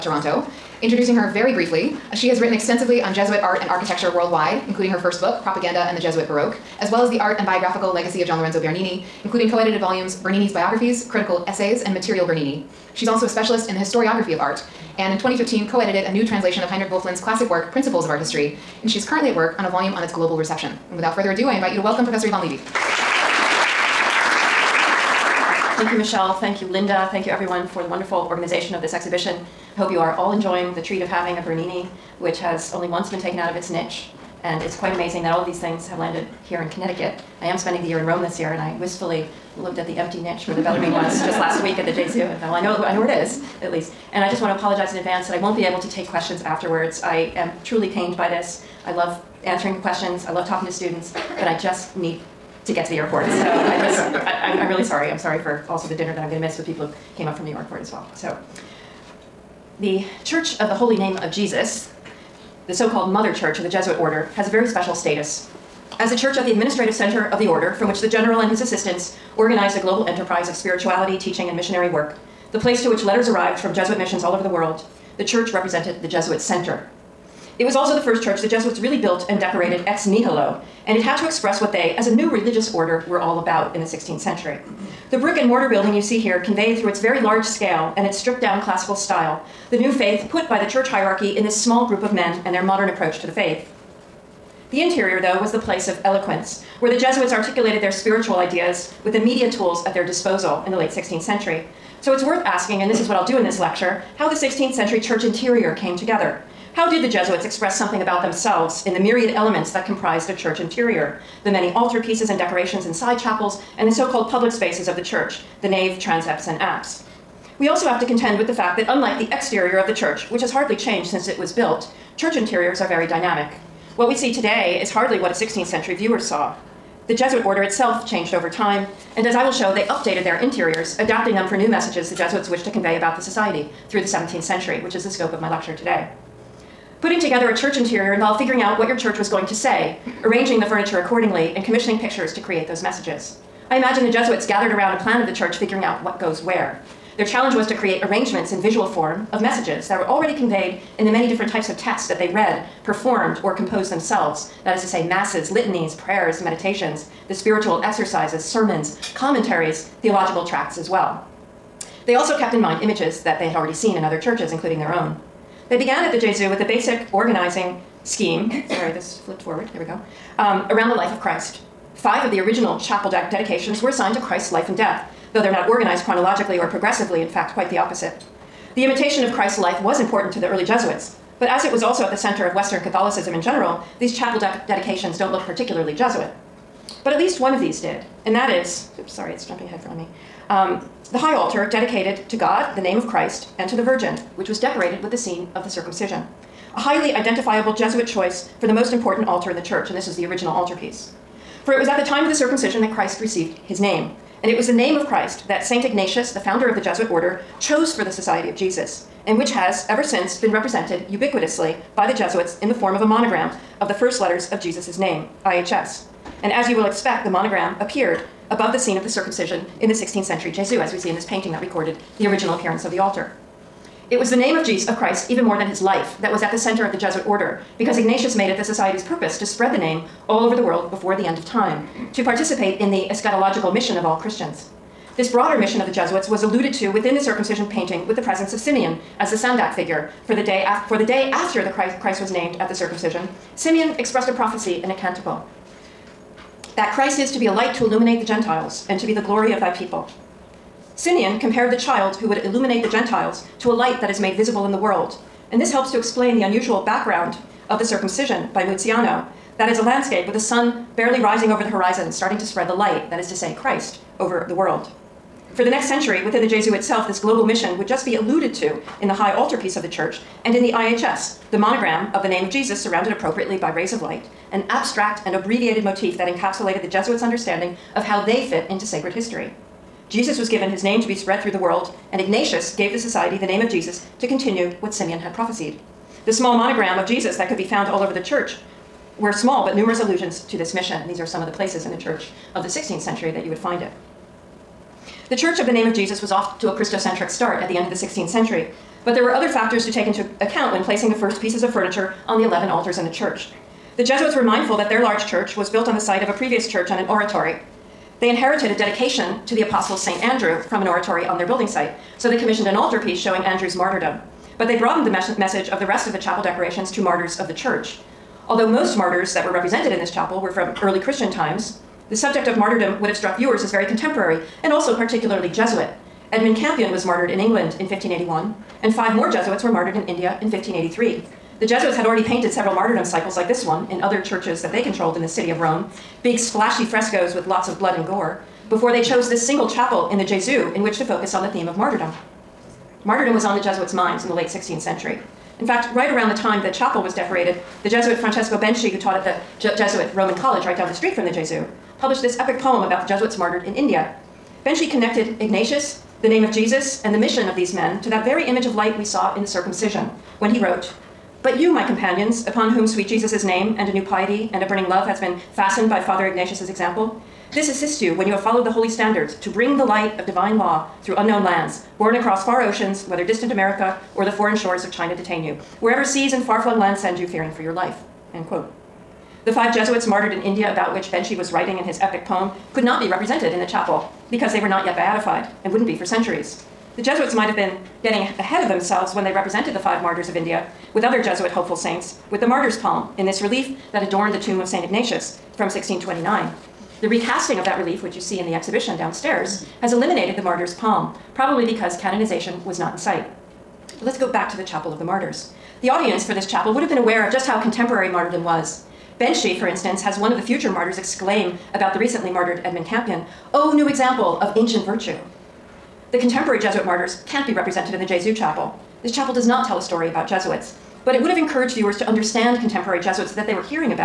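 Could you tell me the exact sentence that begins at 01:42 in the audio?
So it's worth asking, and this is what I'll do in this lecture, how the 16th century church interior came together.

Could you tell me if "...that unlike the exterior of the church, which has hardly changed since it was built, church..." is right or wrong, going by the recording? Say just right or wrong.
right.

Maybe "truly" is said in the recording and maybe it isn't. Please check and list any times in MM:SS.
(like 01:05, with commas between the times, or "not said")
00:47.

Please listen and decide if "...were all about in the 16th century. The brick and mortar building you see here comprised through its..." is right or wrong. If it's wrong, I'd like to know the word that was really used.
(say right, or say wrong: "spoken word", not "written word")
wrong: "conveyed", not "comprised".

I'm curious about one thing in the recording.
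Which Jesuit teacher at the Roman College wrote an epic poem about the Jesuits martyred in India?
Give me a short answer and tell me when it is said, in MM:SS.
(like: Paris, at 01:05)
Francesco Benci, at 05:48.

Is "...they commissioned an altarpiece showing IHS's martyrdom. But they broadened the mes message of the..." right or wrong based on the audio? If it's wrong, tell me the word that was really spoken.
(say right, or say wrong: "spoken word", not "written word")
wrong: "Andrew", not "IHS".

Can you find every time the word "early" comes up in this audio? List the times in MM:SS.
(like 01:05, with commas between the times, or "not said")
03:00, 05:20.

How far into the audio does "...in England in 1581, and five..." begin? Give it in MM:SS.
05:27.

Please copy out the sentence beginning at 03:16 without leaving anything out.
A highly identifiable Jesuit choice for the most important altar in the church, and this is the original altarpiece.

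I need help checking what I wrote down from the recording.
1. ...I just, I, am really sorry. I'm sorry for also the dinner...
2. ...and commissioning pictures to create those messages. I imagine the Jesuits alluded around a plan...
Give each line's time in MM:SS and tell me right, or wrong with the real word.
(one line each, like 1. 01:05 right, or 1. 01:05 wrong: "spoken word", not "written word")
1. 00:53 right
2. 02:21 wrong: "gathered", not "alluded".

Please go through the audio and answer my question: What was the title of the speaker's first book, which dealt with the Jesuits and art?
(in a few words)
Propaganda and the Jesuit Baroque.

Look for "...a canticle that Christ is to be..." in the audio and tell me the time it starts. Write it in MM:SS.
04:04.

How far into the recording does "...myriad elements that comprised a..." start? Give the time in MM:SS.
01:49.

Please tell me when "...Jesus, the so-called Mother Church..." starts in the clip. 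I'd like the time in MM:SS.
01:01.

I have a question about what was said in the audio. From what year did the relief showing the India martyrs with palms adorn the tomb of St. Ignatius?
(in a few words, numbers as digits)
1629.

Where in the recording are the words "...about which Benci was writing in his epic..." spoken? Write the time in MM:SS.
06:20.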